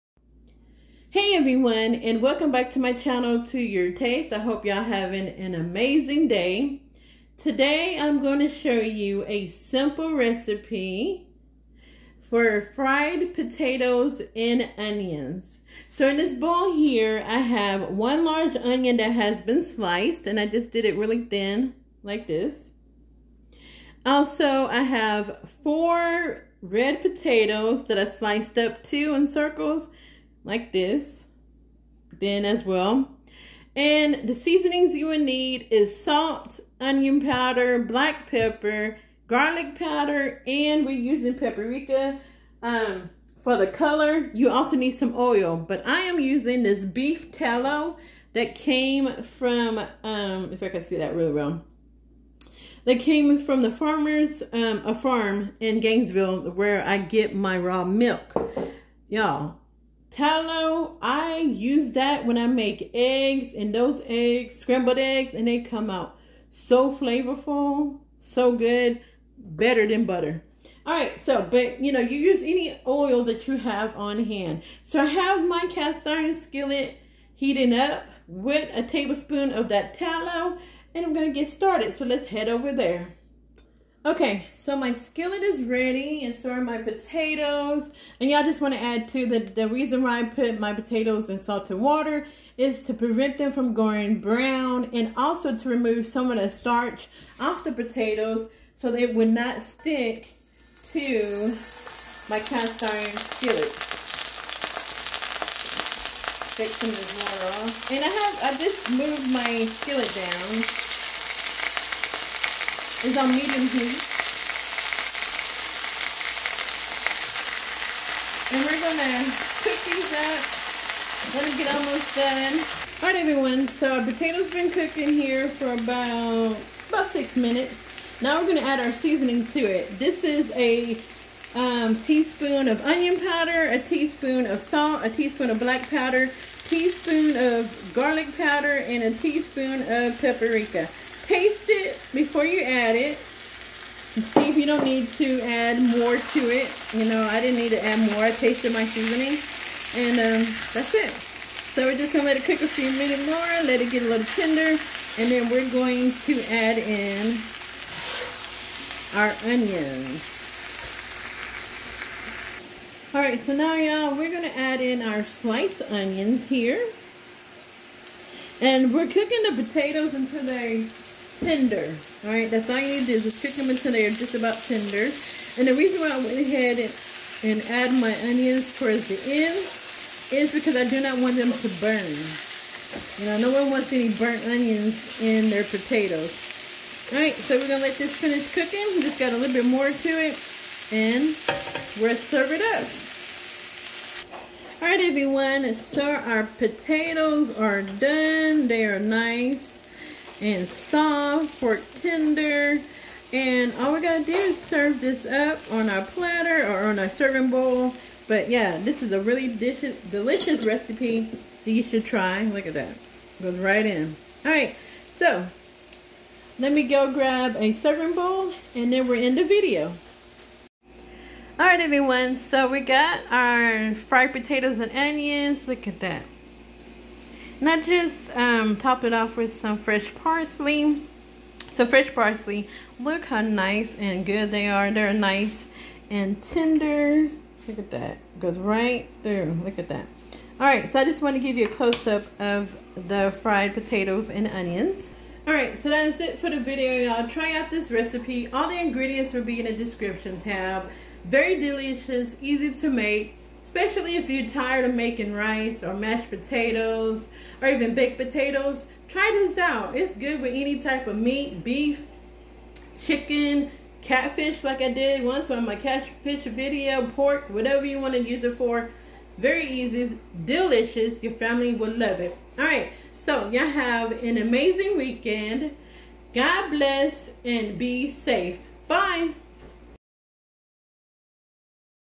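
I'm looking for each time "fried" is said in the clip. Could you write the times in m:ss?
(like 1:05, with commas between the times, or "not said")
0:12, 3:43, 4:03.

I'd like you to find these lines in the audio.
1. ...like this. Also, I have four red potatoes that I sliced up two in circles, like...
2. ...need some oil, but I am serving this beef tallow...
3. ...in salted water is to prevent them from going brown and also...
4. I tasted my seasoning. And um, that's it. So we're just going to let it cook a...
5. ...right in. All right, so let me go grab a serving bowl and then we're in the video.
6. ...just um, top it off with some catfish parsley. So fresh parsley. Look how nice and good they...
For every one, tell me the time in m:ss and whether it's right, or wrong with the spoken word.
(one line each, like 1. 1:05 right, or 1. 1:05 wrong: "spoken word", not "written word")
1. 0:22 right
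2. 0:44 wrong: "using", not "serving"
3. 1:31 right
4. 2:28 right
5. 3:33 right
6. 3:47 wrong: "fresh", not "catfish".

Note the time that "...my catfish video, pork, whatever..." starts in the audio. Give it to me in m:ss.
4:25.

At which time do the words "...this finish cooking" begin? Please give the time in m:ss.
3:07.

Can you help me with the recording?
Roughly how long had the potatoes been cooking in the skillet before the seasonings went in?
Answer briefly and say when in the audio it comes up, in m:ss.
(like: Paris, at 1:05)
6 minutes, at 2:07.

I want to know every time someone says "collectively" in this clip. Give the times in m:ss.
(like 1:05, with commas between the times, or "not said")
not said.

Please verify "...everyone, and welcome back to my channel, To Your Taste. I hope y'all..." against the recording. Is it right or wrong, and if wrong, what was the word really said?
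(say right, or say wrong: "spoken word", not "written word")
right.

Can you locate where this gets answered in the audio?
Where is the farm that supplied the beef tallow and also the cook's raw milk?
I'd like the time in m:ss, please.
0:55.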